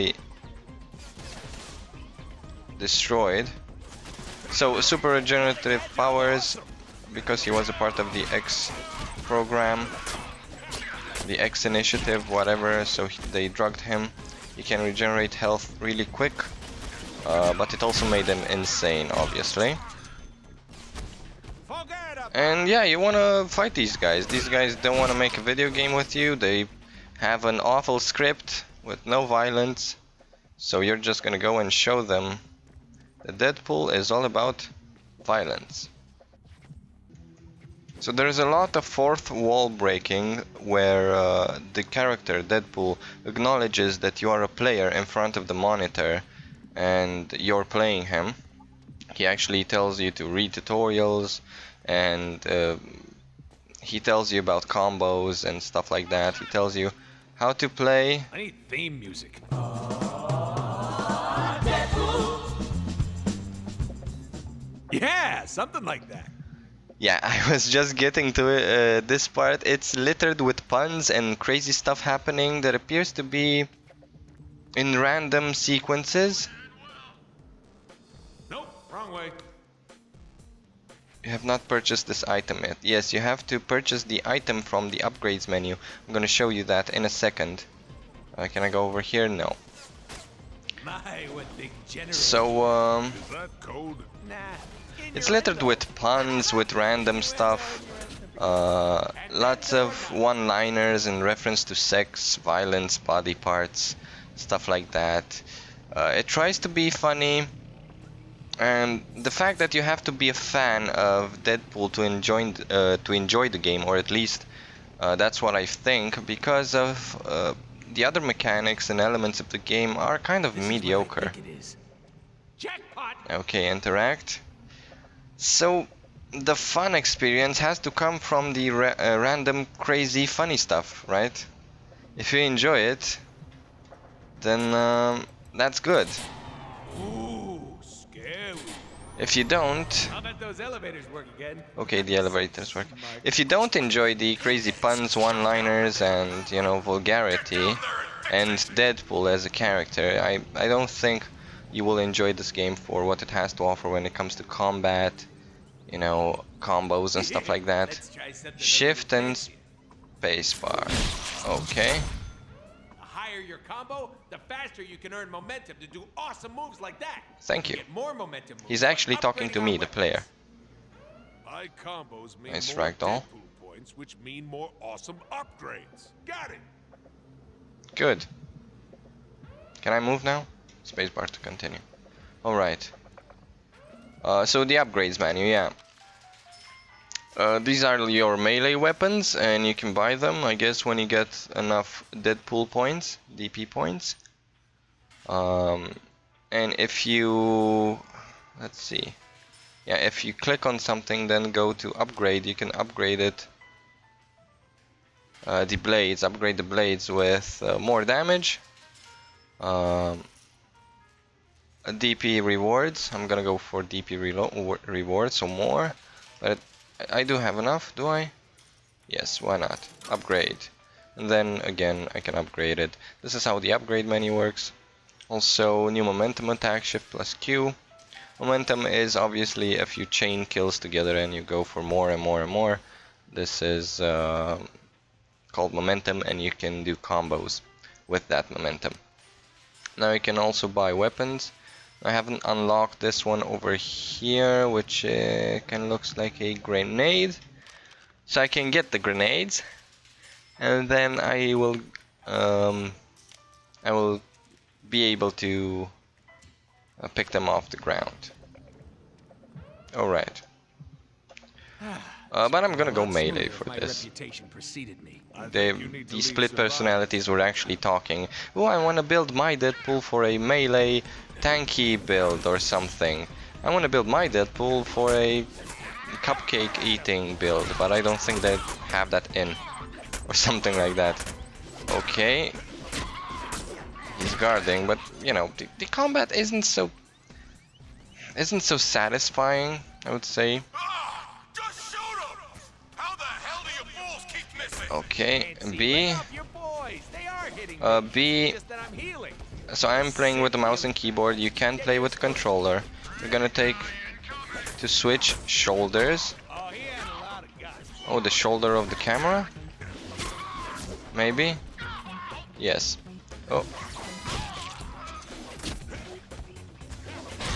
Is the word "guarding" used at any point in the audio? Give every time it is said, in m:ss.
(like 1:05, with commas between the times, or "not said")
4:44.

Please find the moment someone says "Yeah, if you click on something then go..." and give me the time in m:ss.
3:19.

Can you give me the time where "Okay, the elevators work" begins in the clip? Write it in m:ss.
2:21.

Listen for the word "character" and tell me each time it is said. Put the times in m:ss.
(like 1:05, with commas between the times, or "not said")
0:41, 2:29.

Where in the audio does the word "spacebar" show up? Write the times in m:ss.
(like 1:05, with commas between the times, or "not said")
2:39, 3:00.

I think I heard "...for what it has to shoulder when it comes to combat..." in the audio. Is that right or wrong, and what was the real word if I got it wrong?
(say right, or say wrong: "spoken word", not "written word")
wrong: "offer", not "shoulder".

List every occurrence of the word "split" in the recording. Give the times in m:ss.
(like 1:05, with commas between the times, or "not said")
4:26.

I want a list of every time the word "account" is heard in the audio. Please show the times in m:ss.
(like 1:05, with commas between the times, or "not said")
not said.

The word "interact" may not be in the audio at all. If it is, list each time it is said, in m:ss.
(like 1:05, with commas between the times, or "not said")
2:03.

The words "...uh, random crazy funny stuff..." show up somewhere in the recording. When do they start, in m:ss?
2:08.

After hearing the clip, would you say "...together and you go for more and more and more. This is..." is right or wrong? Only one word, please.
right.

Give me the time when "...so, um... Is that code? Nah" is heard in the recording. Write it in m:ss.
1:32.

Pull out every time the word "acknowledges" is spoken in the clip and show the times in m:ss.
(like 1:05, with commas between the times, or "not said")
0:43.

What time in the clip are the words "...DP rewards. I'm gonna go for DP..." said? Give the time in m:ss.
3:31.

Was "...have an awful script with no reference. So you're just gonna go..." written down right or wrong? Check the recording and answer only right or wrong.
wrong.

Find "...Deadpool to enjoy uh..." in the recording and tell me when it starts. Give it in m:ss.
1:51.